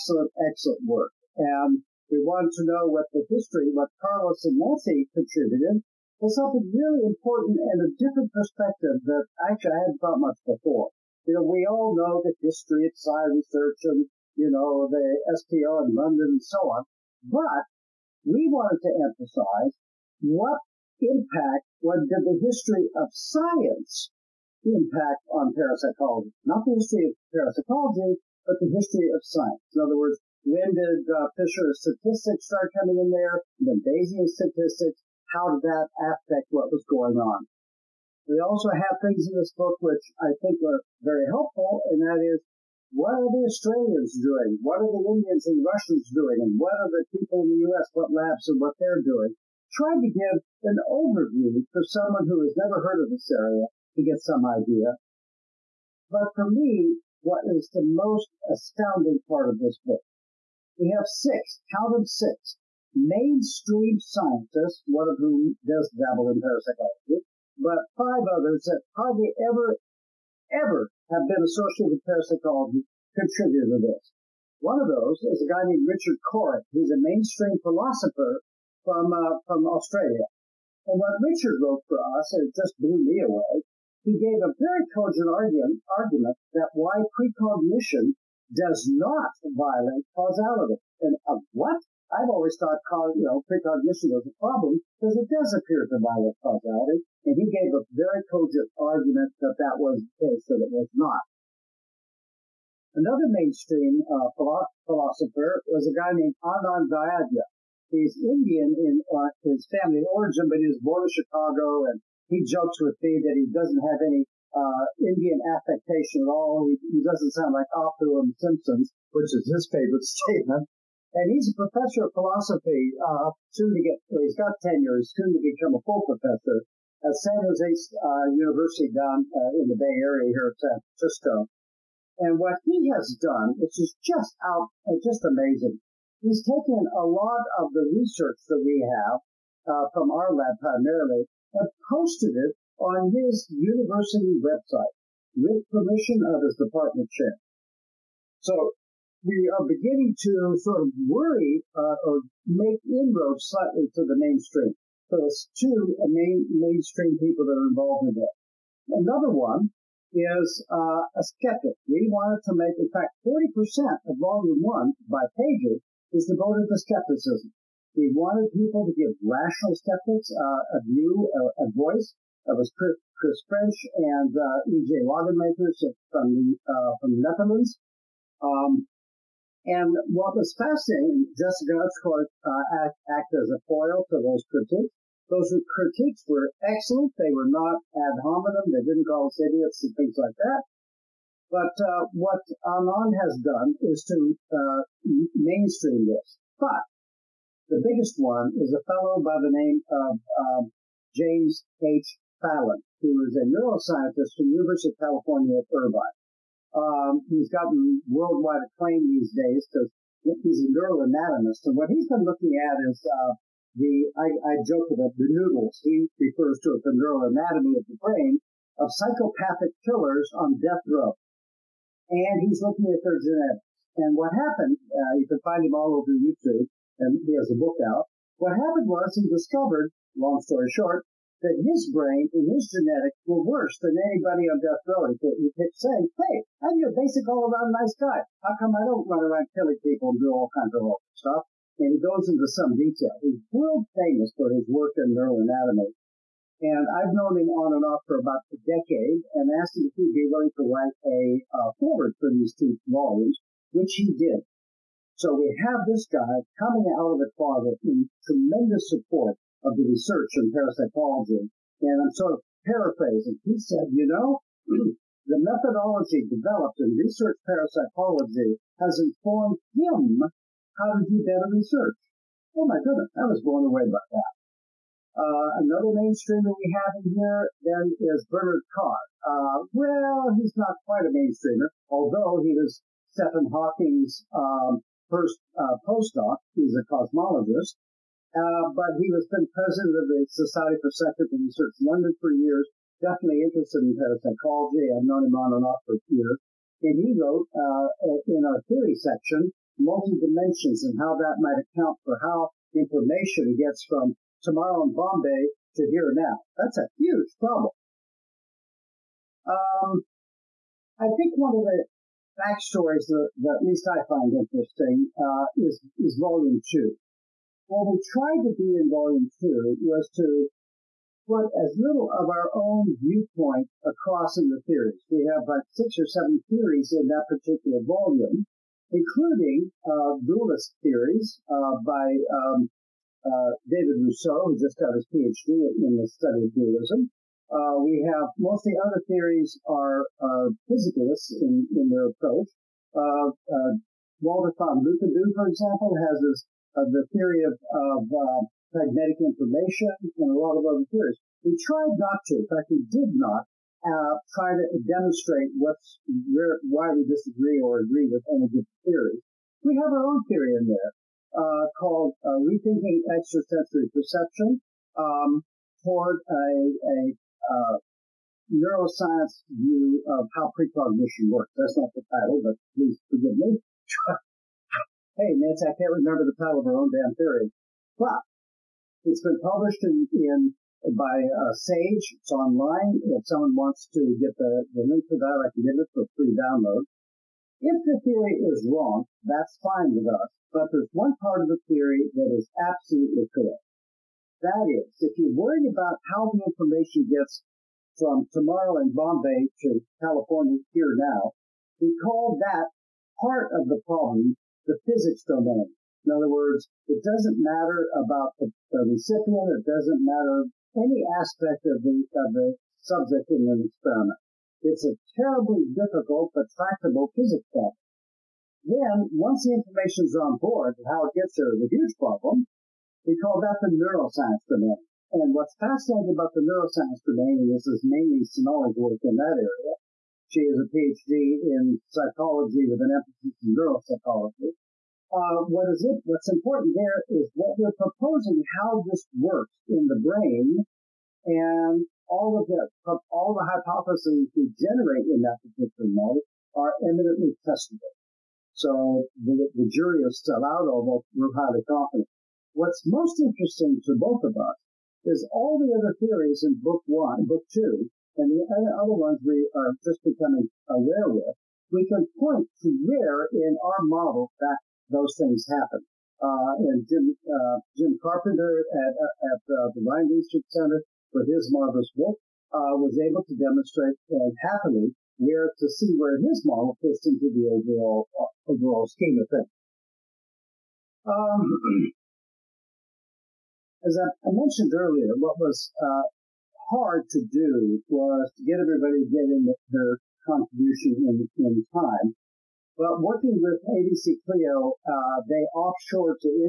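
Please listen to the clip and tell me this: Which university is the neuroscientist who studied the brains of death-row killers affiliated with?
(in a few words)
University of California at Irvine.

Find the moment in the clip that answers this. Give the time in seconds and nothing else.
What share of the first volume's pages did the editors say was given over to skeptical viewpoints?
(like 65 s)
163 s.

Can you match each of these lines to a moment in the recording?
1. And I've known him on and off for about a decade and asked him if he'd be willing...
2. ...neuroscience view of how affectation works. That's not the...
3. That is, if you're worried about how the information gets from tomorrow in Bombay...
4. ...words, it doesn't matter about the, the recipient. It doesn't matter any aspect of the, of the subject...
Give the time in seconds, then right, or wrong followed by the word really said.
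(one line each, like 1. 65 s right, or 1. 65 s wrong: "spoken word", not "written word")
1. 246 s right
2. 368 s wrong: "precognition", not "affectation"
3. 394 s right
4. 406 s right.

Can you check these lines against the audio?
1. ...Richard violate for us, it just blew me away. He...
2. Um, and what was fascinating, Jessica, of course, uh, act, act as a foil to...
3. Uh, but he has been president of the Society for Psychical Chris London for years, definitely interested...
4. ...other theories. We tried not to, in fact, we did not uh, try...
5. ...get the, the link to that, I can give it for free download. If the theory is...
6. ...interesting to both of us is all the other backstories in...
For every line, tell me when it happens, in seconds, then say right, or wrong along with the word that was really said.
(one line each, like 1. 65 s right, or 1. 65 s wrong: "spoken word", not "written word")
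1. 81 s wrong: "wrote", not "violate"
2. 178 s right
3. 288 s wrong: "Research", not "Chris"
4. 350 s right
5. 384 s right
6. 453 s wrong: "theories", not "backstories".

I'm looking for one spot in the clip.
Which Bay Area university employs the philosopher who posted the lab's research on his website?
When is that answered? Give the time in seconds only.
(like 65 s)
127 s.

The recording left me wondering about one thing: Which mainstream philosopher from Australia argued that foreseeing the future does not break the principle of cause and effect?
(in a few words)
Richard Corry.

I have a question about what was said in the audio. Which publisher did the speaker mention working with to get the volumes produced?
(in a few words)
ABC Clio.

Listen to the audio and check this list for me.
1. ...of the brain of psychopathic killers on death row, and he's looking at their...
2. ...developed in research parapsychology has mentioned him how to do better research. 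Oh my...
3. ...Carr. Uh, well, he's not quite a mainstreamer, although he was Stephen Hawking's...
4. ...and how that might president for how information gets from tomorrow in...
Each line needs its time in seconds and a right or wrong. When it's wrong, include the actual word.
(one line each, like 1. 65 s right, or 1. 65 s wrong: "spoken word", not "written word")
1. 217 s right
2. 266 s wrong: "informed", not "mentioned"
3. 278 s right
4. 300 s wrong: "account", not "president".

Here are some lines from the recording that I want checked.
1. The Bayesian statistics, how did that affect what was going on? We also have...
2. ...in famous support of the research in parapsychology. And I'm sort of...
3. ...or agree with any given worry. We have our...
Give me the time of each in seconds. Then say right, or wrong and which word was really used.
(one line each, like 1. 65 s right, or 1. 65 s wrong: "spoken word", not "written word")
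1. 33 s right
2. 257 s wrong: "tremendous", not "famous"
3. 357 s wrong: "theory", not "worry".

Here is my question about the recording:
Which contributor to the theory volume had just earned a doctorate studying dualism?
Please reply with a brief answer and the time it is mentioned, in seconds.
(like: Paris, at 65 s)
David Rousseau, at 333 s.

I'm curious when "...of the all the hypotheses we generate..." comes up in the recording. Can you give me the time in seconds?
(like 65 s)
442 s.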